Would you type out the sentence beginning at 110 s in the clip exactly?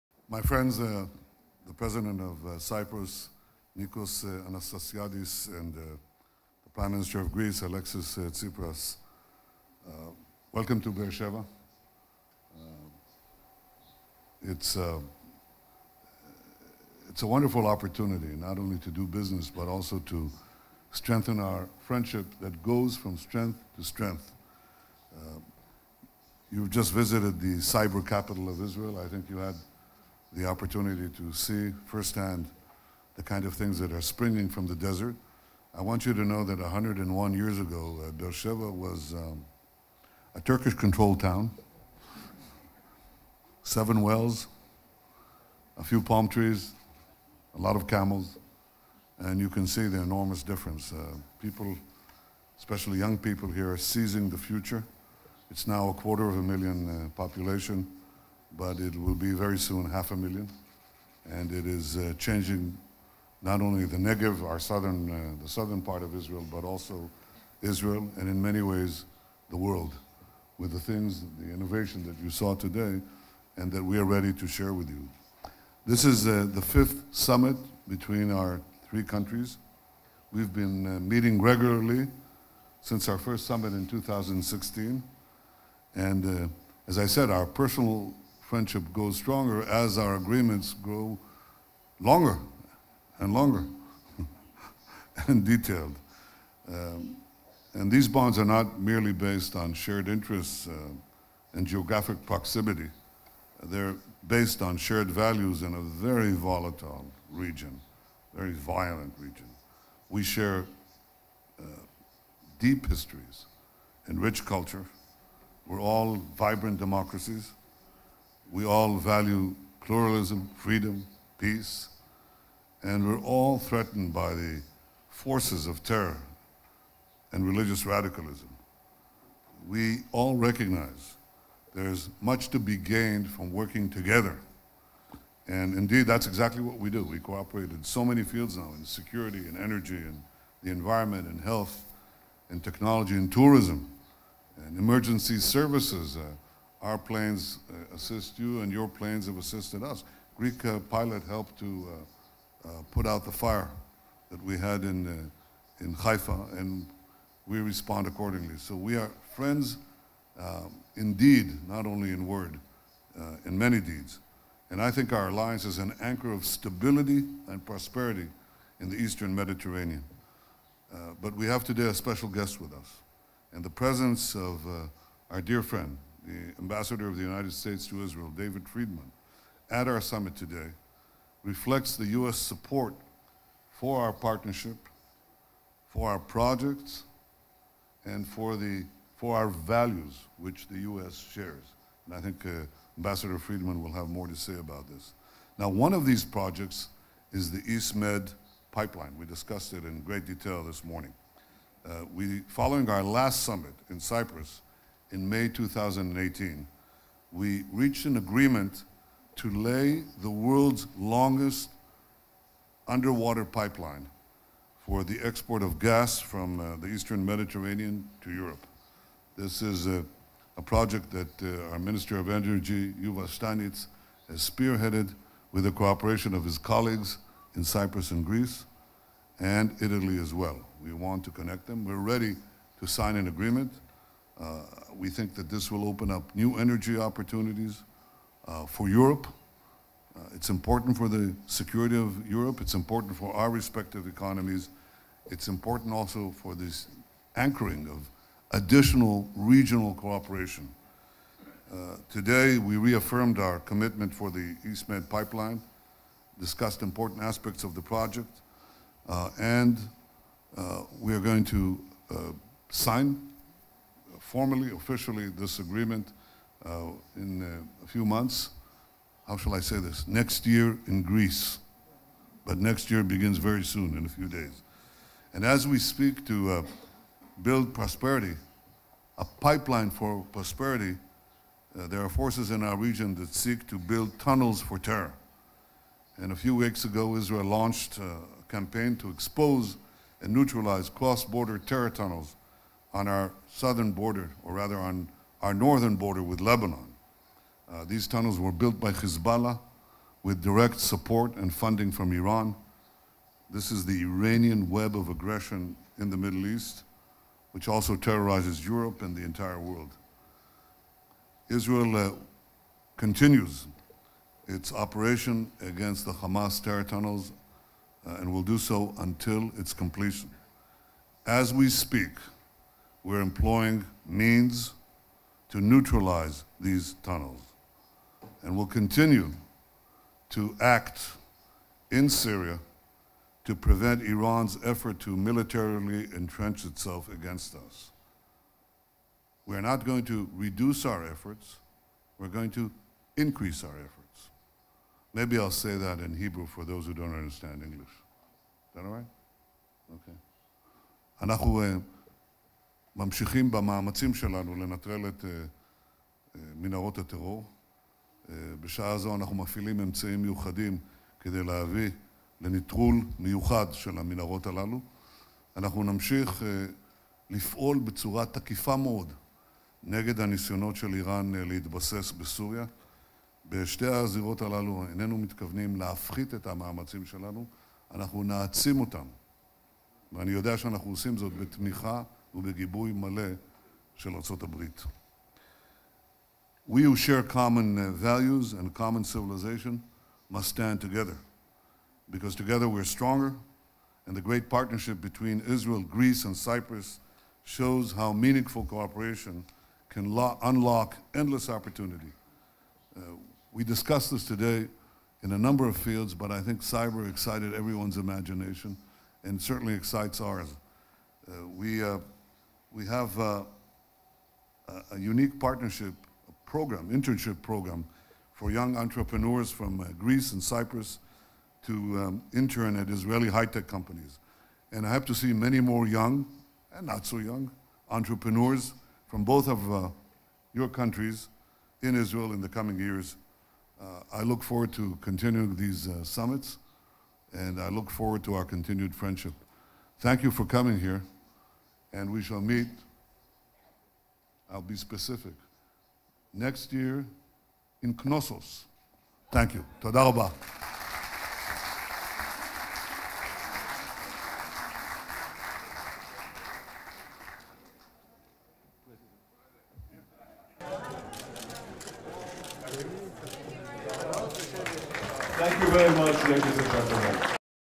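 We share uh, deep histories and rich culture.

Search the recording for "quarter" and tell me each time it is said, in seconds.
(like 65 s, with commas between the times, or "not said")
55 s.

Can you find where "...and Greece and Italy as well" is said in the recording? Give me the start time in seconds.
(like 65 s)
228 s.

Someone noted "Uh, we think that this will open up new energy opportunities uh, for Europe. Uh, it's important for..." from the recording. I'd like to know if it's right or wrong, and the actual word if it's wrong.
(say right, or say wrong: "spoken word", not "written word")
right.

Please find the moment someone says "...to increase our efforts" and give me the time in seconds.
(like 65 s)
342 s.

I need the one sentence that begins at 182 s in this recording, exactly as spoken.
support for our partnership, for our projects, and for, the, for our values, which the U.S.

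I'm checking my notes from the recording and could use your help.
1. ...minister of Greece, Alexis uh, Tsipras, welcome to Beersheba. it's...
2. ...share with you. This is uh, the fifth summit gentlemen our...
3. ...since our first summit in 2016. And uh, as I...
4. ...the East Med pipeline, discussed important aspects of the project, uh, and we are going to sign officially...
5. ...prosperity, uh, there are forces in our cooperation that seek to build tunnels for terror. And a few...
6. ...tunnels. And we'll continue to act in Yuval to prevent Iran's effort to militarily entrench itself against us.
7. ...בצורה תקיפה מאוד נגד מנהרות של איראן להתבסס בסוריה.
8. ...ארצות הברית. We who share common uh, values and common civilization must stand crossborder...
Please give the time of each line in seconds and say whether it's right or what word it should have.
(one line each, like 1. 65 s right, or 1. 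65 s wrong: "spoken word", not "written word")
1. 6 s right
2. 74 s wrong: "between", not "gentlemen"
3. 82 s right
4. 254 s wrong: "formally", not "officially"
5. 280 s wrong: "region", not "cooperation"
6. 327 s wrong: "Syria", not "Yuval"
7. 367 s wrong: "הניסיונות", not "מנהרות"
8. 384 s wrong: "together", not "crossborder".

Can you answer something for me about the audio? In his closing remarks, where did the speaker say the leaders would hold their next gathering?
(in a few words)
Knossos.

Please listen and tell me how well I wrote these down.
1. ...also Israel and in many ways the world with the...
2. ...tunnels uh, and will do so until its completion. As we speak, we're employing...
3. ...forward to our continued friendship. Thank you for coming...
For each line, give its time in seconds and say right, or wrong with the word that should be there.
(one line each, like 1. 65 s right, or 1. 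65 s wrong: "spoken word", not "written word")
1. 66 s right
2. 316 s right
3. 437 s right.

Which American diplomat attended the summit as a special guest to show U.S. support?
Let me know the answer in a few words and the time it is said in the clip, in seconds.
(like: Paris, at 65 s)
David Friedman, at 178 s.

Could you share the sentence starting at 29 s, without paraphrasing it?
I think you had the opportunity to see firsthand the kind of things that are springing from the desert.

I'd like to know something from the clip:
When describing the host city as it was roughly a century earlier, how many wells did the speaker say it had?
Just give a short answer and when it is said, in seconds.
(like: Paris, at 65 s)
7, at 43 s.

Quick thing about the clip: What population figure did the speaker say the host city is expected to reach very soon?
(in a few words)
half a million.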